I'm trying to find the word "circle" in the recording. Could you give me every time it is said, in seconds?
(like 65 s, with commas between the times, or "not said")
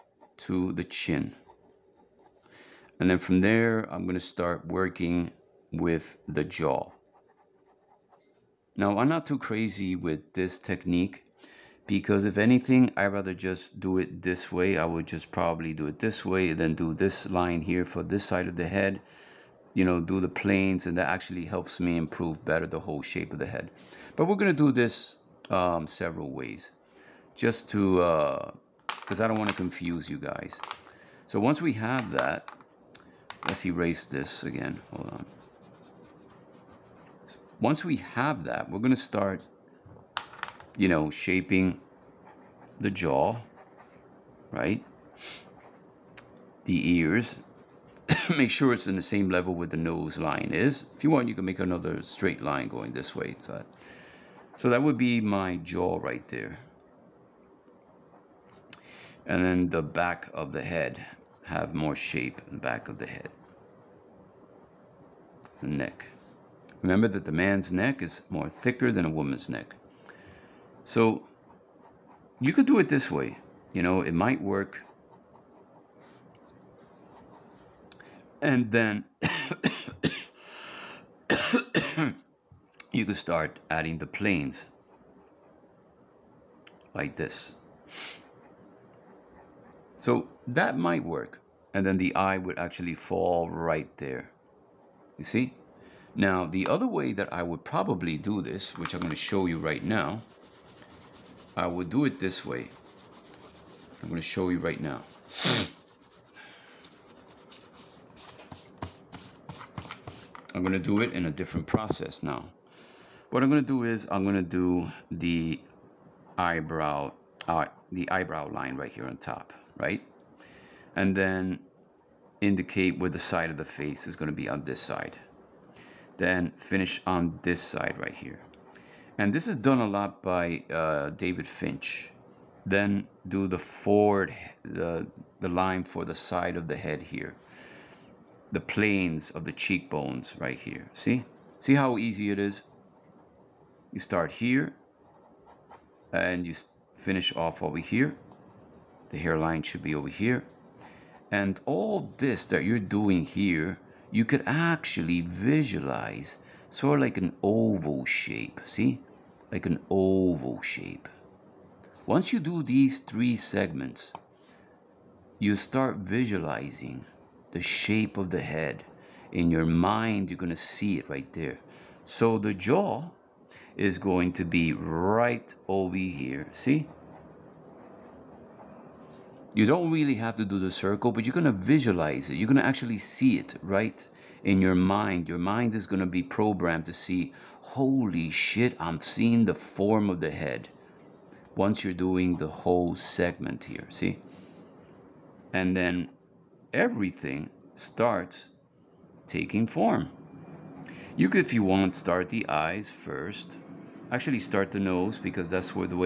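180 s.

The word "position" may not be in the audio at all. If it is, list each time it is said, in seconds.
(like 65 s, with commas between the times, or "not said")
not said.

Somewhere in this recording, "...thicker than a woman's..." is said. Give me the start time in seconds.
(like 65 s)
68 s.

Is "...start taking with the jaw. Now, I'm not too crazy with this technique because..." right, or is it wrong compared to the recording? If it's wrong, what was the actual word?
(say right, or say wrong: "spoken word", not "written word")
wrong: "working", not "taking".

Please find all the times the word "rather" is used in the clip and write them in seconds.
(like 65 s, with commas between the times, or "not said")
13 s.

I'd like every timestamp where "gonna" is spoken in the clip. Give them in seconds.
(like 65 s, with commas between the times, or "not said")
4 s, 24 s, 38 s.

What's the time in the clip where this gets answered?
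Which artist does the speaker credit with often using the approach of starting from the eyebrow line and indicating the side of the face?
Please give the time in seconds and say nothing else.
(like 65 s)
131 s.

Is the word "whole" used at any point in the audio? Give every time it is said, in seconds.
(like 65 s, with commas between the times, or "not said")
22 s, 192 s.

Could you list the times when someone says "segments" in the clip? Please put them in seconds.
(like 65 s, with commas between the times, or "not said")
163 s, 192 s.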